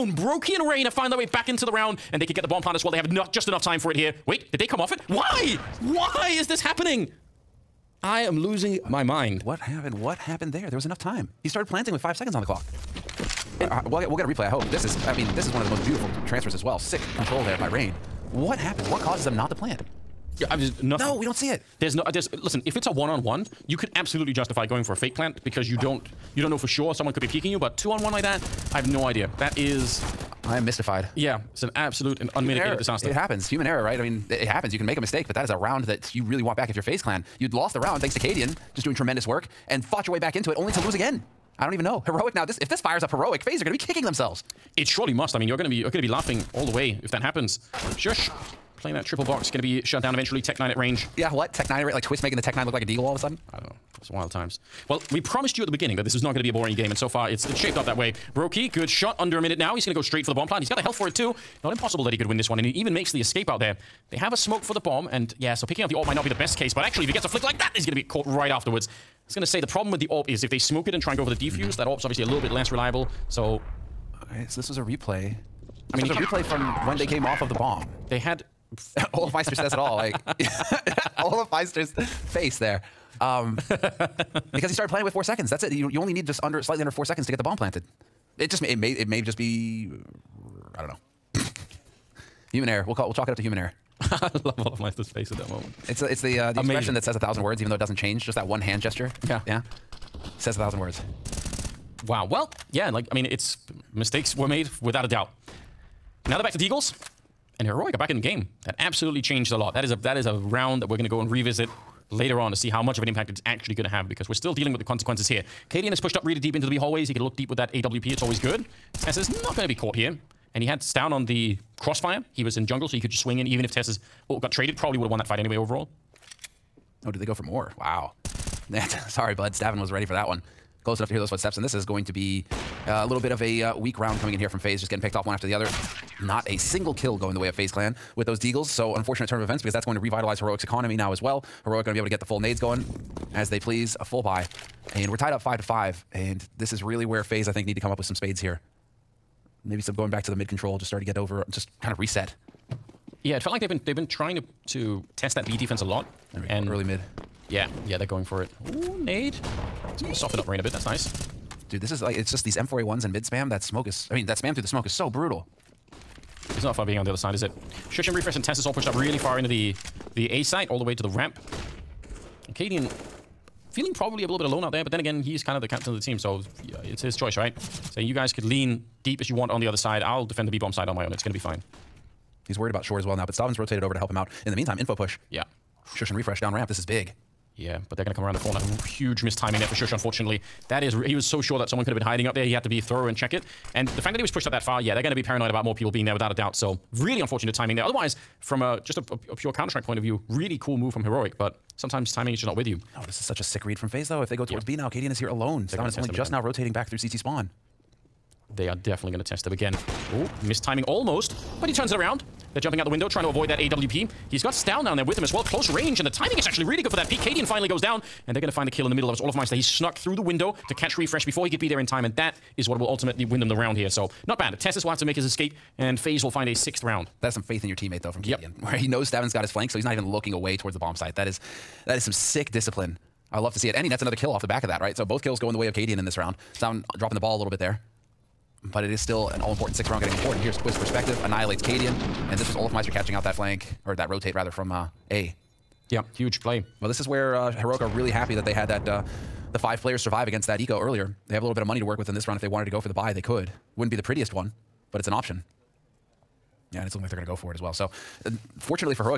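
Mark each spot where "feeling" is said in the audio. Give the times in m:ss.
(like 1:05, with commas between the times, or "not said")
2:53.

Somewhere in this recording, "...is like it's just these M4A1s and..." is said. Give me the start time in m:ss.
2:41.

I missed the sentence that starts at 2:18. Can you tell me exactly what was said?
So unfortunate turn of events because that's going to revitalize Heroic's economy now as well.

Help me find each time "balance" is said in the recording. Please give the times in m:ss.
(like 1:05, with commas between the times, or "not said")
not said.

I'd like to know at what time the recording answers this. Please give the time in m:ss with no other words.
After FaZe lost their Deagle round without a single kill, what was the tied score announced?
2:25.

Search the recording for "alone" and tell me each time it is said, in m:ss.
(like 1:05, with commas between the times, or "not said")
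2:54, 3:25.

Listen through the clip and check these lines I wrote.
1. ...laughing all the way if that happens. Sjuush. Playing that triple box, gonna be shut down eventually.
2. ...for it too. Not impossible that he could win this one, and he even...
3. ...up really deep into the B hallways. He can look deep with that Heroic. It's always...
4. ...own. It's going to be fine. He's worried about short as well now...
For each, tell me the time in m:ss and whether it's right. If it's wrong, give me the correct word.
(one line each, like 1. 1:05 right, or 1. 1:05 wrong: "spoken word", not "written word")
1. 0:46 right
2. 1:00 right
3. 1:56 wrong: "AWP", not "Heroic"
4. 3:01 right.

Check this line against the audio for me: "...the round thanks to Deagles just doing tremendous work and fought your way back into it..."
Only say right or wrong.
wrong.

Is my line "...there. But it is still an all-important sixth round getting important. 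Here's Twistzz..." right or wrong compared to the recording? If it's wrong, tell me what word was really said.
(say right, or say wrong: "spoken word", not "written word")
right.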